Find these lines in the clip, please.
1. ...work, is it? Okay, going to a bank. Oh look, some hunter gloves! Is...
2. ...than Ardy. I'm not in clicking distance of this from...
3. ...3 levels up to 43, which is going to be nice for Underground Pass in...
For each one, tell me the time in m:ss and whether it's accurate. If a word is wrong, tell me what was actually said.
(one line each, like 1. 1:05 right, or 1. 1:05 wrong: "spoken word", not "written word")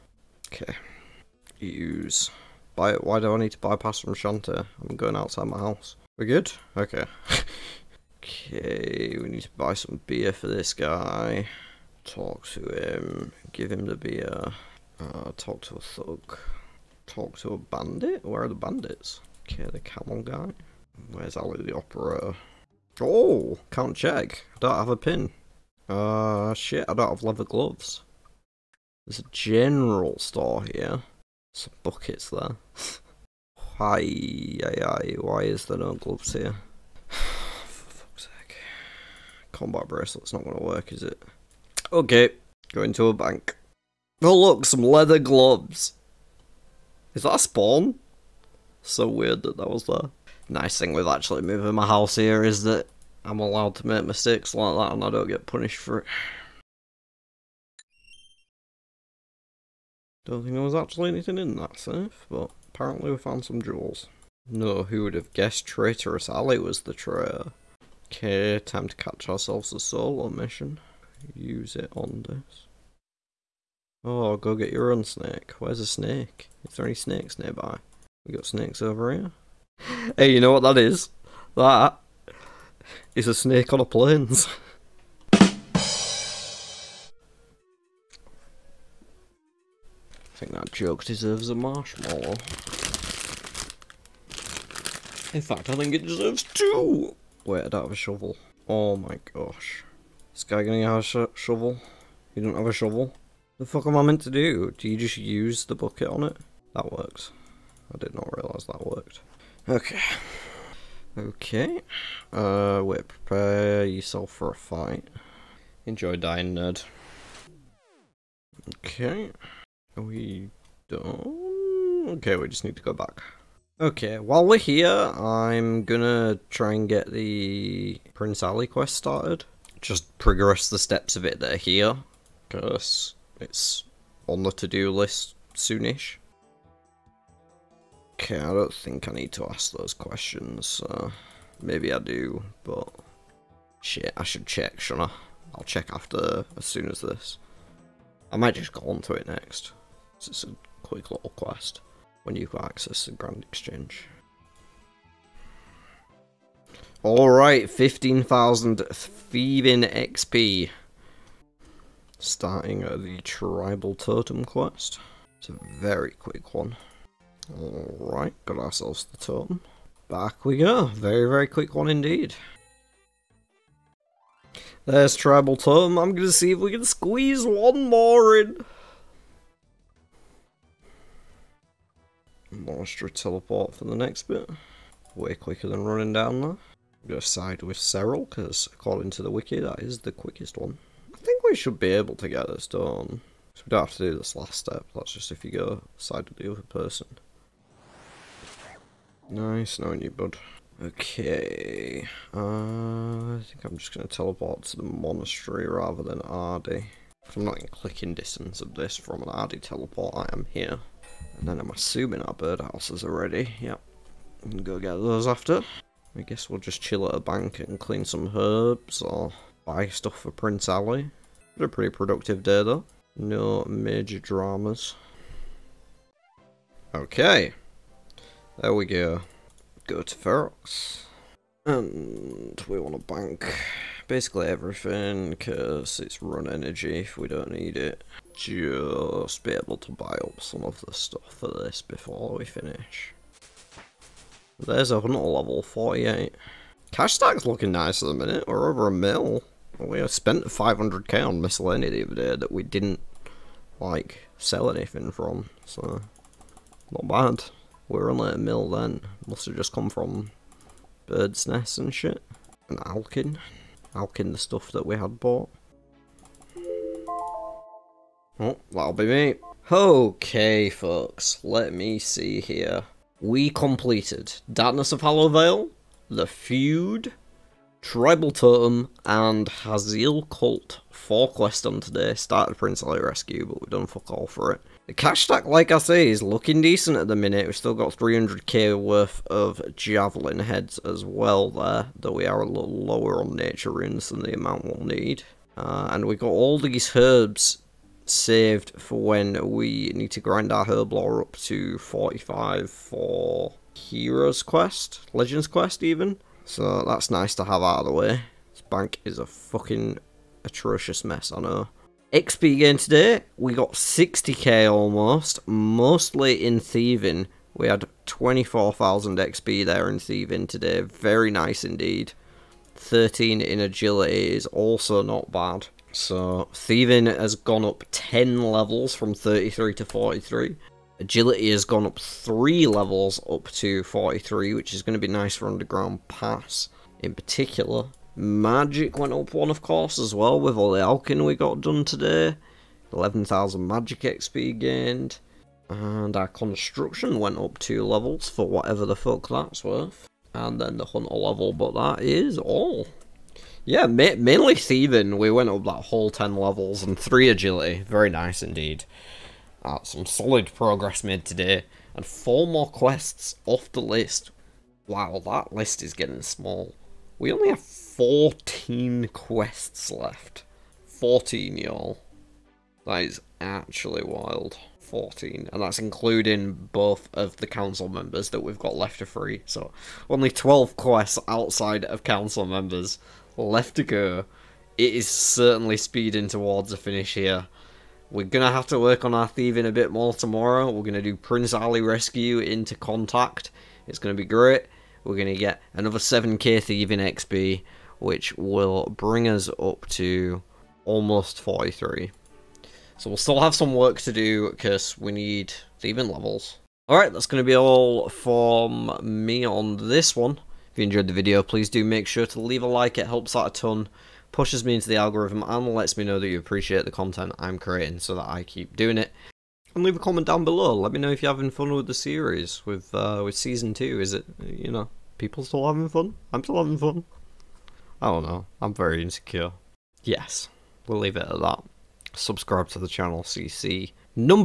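1. 0:40 wrong: "leather", not "hunter"
2. 3:26 right
3. 5:31 right.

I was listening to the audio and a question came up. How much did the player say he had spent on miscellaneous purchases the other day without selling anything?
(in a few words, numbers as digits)
500k.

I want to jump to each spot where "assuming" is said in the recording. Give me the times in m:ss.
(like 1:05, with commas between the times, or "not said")
3:31.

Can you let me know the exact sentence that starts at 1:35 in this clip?
In fact, I think it deserves two!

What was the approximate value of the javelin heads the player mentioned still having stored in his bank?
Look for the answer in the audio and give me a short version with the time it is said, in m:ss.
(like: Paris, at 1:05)
300k, at 4:47.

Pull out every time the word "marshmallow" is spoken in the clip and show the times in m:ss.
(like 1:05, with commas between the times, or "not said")
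1:31.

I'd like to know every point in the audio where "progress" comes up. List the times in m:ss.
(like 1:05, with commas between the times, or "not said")
2:10, 6:00.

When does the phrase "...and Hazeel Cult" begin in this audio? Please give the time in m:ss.
4:39.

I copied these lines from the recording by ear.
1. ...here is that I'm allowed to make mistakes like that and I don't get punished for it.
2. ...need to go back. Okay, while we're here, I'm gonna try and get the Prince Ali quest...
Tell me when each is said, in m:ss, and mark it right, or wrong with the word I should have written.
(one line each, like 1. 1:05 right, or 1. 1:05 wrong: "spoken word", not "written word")
1. 0:52 right
2. 2:02 right.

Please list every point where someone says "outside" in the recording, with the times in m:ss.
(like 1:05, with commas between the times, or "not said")
0:05, 6:21.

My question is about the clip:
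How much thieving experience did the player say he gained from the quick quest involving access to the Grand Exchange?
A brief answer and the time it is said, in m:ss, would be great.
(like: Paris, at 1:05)
15,000, at 2:37.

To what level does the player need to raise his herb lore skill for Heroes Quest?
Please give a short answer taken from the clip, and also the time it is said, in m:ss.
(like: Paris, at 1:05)
45, at 5:01.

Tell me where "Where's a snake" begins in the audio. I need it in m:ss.
1:15.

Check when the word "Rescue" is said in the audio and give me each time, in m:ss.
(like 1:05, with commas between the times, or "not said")
4:43, 6:31.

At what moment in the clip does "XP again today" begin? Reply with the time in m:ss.
5:12.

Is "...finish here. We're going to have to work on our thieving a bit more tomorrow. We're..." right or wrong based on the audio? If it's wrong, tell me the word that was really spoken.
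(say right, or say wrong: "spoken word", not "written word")
right.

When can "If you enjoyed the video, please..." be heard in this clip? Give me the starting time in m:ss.
6:50.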